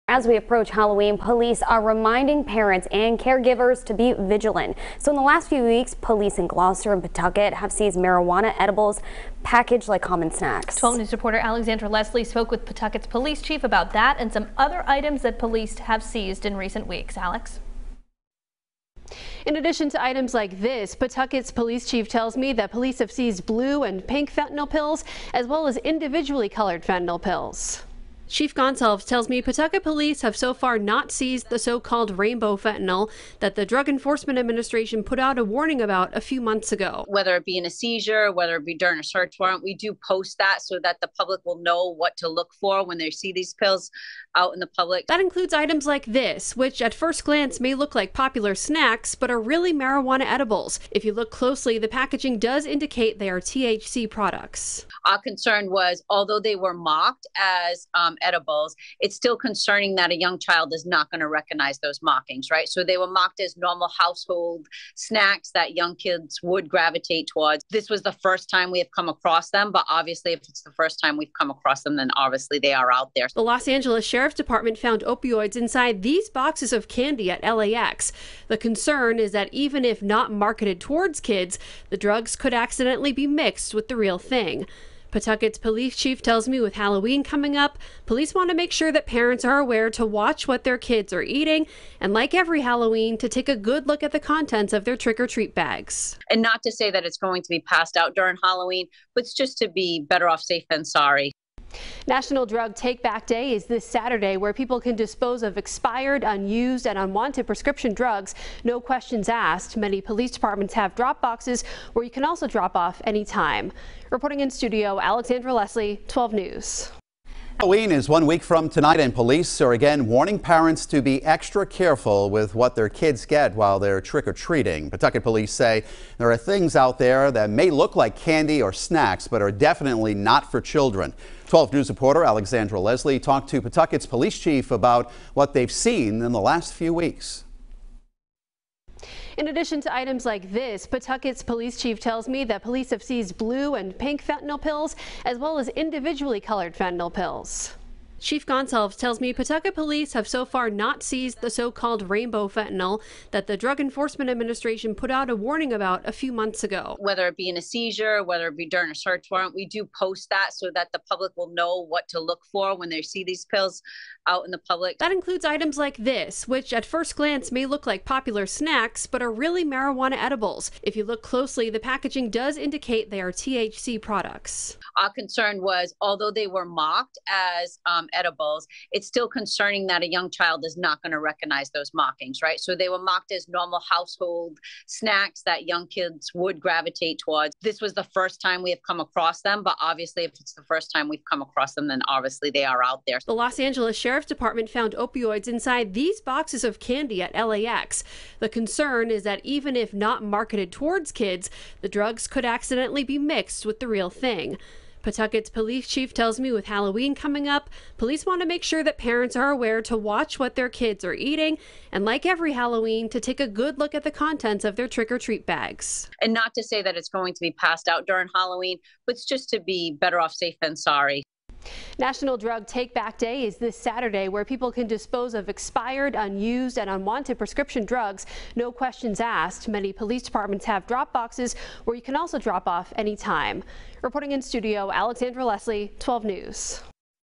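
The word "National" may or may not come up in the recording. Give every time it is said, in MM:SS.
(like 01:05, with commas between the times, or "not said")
01:42, 03:41.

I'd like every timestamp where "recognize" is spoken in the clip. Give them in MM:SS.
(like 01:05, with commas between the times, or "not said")
01:01, 03:01.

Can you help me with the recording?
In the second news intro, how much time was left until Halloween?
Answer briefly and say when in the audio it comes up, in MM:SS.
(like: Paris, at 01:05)
One week, at 01:58.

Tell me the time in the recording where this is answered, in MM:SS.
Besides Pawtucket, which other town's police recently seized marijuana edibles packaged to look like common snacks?
00:06.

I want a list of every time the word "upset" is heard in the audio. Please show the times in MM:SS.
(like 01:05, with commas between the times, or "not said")
not said.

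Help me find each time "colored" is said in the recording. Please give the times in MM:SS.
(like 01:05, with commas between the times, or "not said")
00:26, 02:26.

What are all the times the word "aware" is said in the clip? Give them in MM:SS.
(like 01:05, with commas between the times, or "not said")
01:29, 03:29.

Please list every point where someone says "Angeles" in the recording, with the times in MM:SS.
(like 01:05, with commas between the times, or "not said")
01:13, 03:13.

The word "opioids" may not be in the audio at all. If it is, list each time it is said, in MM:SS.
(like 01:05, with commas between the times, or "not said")
01:15, 03:14.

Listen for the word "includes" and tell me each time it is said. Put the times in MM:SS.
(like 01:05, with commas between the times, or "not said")
00:45, 02:45.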